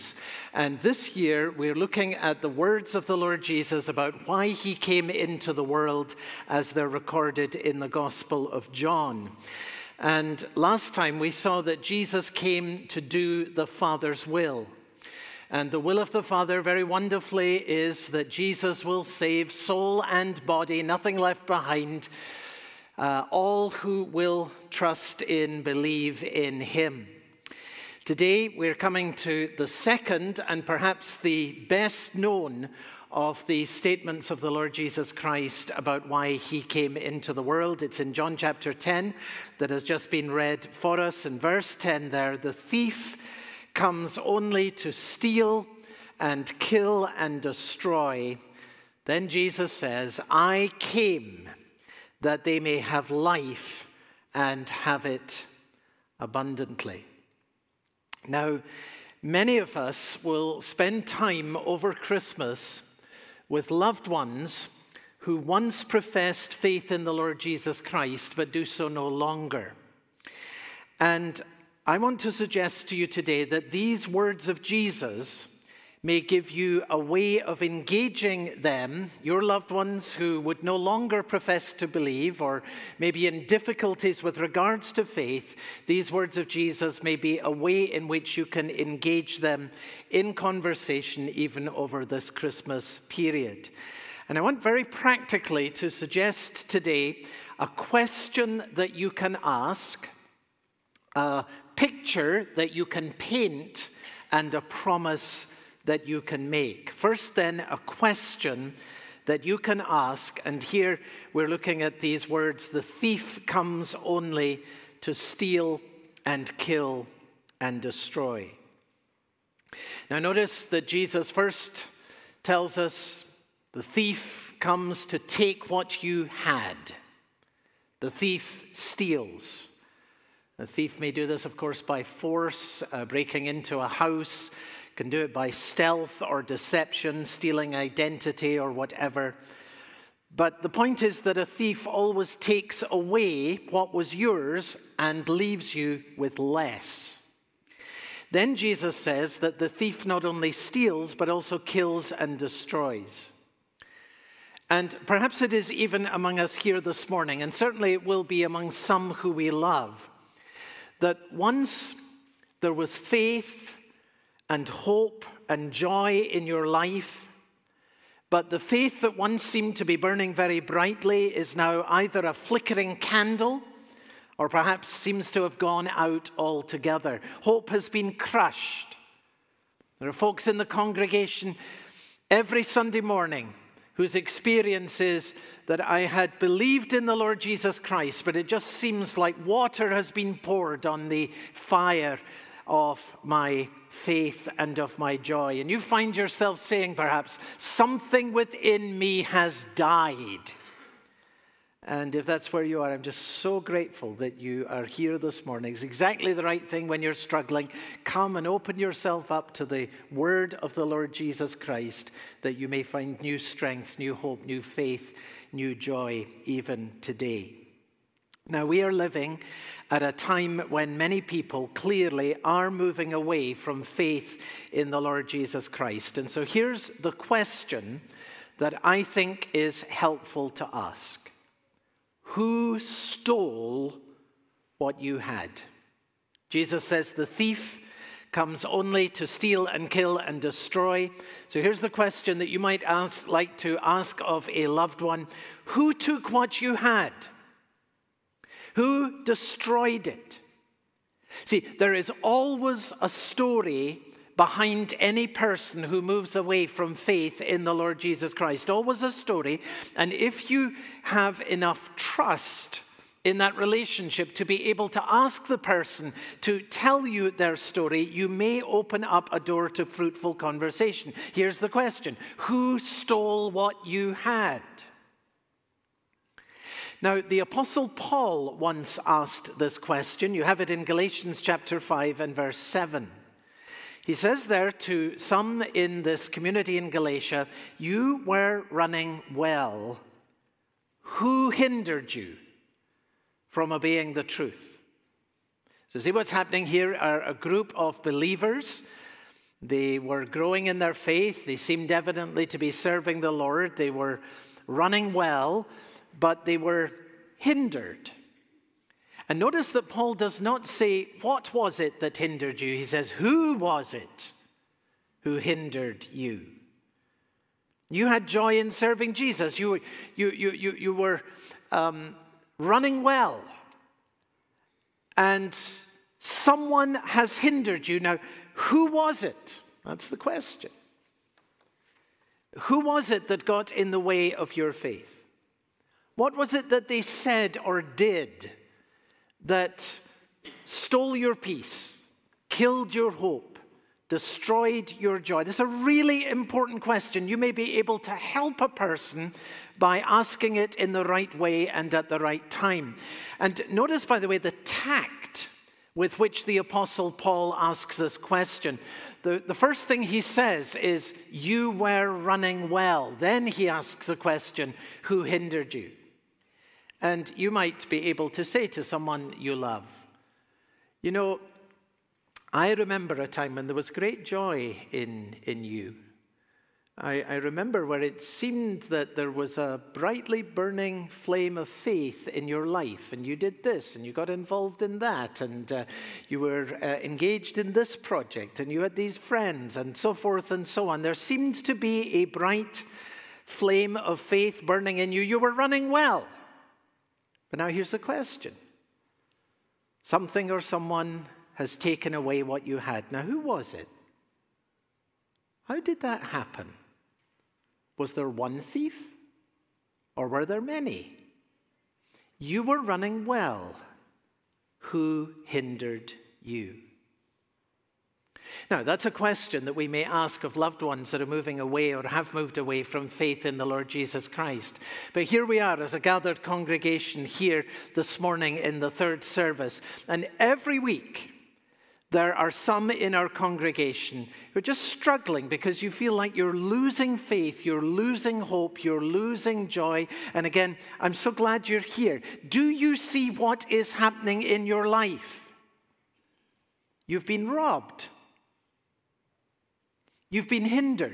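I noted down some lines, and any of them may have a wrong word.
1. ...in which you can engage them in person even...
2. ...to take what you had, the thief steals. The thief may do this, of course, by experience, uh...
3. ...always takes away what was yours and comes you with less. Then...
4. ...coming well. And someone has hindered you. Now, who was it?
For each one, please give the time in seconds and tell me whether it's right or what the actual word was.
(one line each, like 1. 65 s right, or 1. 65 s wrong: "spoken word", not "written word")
1. 87 s wrong: "conversation", not "person"
2. 125 s wrong: "force", not "experience"
3. 141 s wrong: "leaves", not "comes"
4. 322 s wrong: "running", not "coming".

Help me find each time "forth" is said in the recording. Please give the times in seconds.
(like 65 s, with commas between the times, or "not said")
390 s.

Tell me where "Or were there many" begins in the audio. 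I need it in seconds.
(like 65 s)
410 s.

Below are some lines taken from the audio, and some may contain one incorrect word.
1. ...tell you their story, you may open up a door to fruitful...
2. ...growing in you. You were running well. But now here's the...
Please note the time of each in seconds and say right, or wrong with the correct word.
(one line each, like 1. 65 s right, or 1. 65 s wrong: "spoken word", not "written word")
1. 266 s right
2. 394 s wrong: "burning", not "growing".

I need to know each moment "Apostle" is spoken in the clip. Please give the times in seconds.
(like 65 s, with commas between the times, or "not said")
277 s, 356 s.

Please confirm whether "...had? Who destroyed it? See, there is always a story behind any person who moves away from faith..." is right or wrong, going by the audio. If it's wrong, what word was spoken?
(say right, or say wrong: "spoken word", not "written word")
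right.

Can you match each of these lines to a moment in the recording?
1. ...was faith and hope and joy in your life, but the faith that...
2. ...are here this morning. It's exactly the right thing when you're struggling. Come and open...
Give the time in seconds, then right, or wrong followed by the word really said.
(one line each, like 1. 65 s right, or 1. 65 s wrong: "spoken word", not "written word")
1. 162 s right
2. 204 s right.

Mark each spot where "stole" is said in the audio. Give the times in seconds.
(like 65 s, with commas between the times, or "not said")
232 s, 272 s, 340 s.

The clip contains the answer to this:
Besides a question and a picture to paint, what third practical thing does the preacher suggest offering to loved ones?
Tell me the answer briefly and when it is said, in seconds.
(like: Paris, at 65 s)
A promise, at 104 s.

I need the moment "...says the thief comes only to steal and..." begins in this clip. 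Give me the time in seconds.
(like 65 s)
236 s.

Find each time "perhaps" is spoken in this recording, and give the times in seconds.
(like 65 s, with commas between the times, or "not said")
30 s, 155 s, 174 s, 196 s.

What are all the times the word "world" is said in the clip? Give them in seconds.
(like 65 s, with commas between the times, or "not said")
5 s, 37 s.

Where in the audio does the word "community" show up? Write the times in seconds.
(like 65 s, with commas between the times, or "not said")
286 s.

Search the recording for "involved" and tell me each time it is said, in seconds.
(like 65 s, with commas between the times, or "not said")
384 s.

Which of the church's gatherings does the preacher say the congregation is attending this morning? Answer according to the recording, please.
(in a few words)
The third service.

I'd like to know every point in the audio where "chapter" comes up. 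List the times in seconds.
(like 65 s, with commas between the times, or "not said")
38 s, 281 s.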